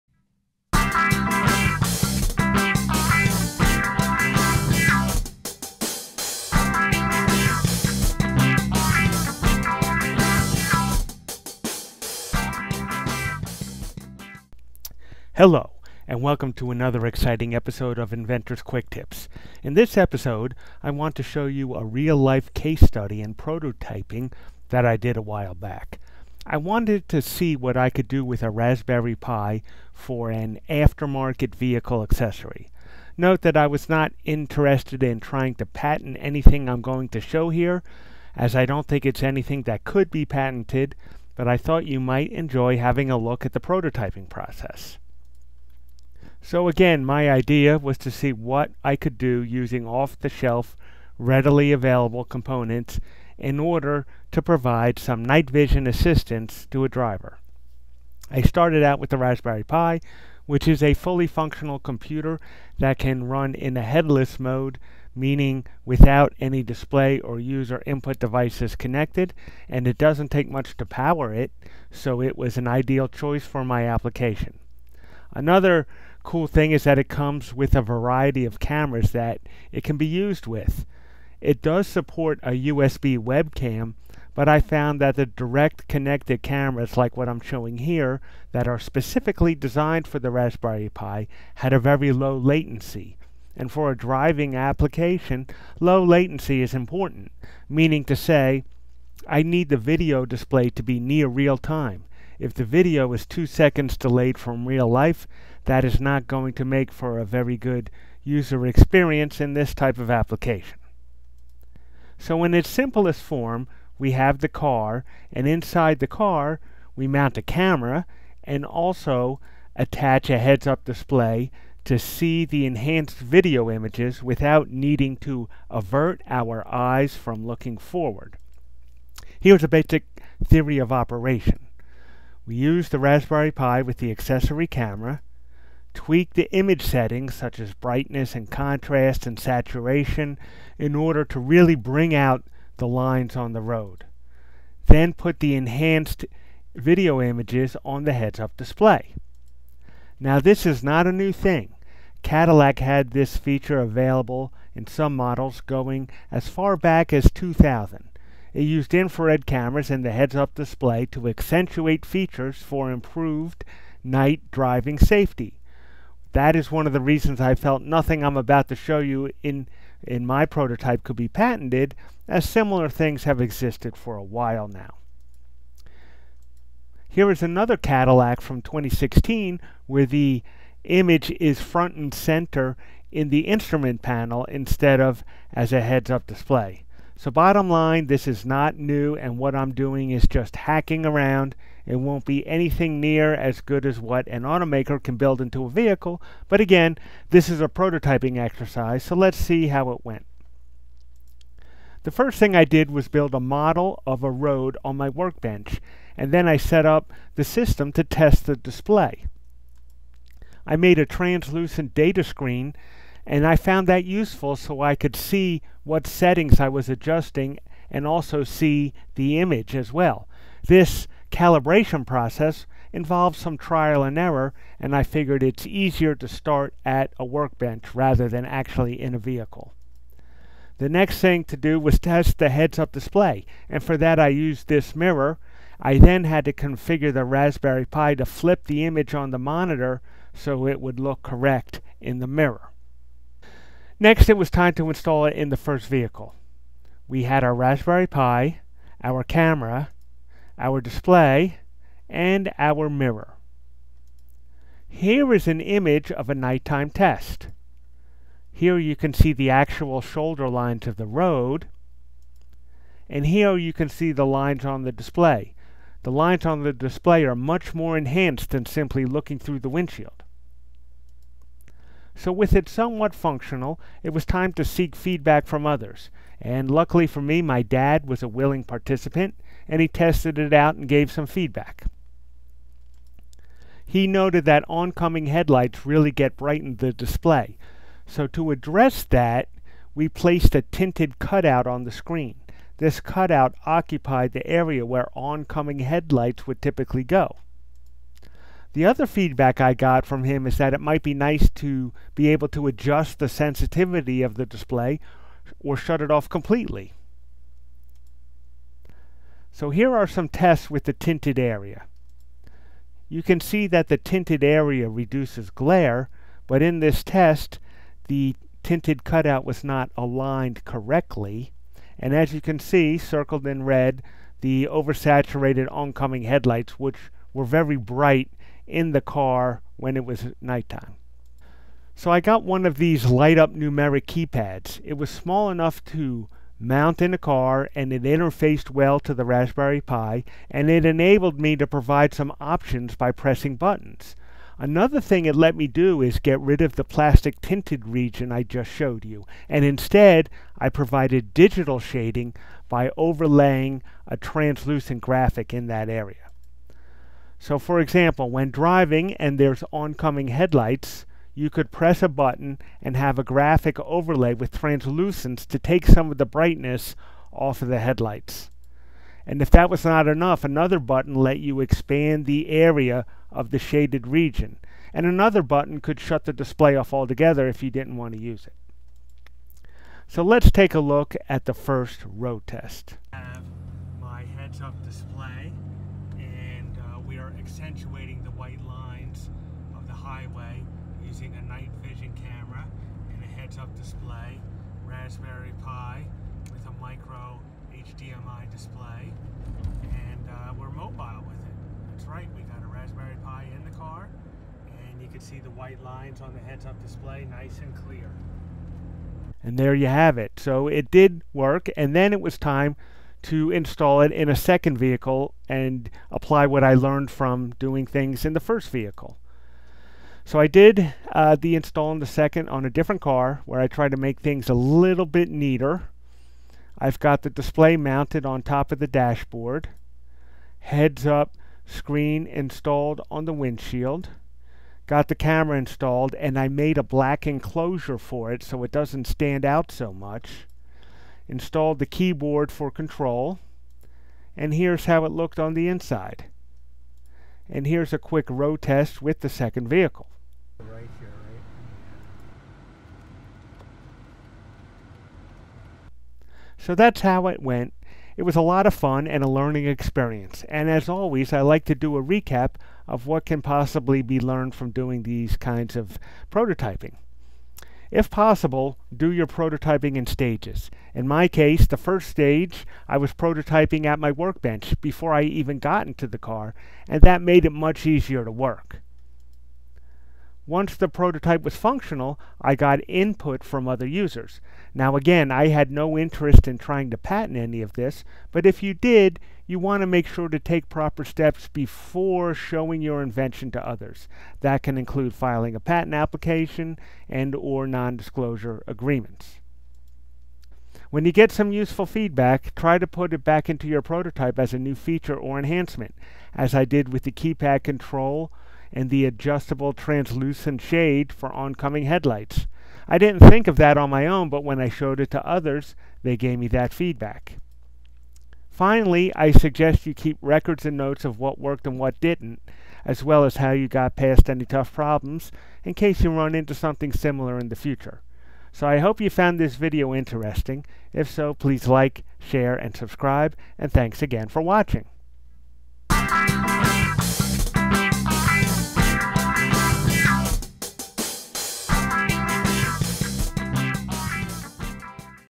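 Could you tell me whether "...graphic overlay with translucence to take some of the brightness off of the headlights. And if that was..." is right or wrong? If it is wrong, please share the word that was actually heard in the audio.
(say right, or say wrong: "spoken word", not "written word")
right.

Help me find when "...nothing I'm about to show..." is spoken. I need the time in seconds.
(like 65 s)
167 s.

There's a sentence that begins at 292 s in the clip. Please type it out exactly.
This cutout occupied the area where oncoming headlights would typically go.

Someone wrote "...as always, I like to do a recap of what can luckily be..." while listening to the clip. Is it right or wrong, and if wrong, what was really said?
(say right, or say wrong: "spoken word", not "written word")
wrong: "possibly", not "luckily".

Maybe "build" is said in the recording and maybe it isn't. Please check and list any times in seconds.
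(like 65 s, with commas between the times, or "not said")
195 s, 203 s.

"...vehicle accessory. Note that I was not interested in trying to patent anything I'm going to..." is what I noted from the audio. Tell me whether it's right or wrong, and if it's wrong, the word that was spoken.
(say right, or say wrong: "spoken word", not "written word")
right.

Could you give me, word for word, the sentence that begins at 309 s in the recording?
So here are some tests with the tinted area.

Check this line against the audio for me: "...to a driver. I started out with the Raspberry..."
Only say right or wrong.
right.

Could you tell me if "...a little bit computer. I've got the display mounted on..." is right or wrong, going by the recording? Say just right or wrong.
wrong.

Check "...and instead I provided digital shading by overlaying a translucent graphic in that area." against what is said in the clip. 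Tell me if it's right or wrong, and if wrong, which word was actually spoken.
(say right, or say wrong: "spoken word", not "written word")
right.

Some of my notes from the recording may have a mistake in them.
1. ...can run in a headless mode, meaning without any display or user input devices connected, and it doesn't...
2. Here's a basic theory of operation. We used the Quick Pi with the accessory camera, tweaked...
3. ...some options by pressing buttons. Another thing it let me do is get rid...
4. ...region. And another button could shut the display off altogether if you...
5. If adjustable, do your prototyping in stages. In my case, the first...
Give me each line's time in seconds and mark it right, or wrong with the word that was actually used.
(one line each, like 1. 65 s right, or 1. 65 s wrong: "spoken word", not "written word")
1. 62 s right
2. 129 s wrong: "Raspberry", not "Quick"
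3. 342 s right
4. 374 s right
5. 467 s wrong: "possible", not "adjustable".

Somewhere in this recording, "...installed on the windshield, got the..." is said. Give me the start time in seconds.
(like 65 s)
432 s.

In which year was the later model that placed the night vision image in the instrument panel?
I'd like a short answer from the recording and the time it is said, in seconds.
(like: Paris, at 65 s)
2016, at 178 s.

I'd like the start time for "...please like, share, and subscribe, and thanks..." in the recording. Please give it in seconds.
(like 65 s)
531 s.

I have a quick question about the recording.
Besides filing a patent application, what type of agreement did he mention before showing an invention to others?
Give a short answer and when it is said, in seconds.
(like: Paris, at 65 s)
non-disclosure agreements, at 497 s.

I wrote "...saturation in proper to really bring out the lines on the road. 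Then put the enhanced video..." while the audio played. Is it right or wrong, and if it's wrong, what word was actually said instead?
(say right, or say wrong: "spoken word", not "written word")
wrong: "order", not "proper".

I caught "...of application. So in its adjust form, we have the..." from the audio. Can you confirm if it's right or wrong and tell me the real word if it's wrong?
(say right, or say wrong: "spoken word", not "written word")
wrong: "simplest", not "adjust".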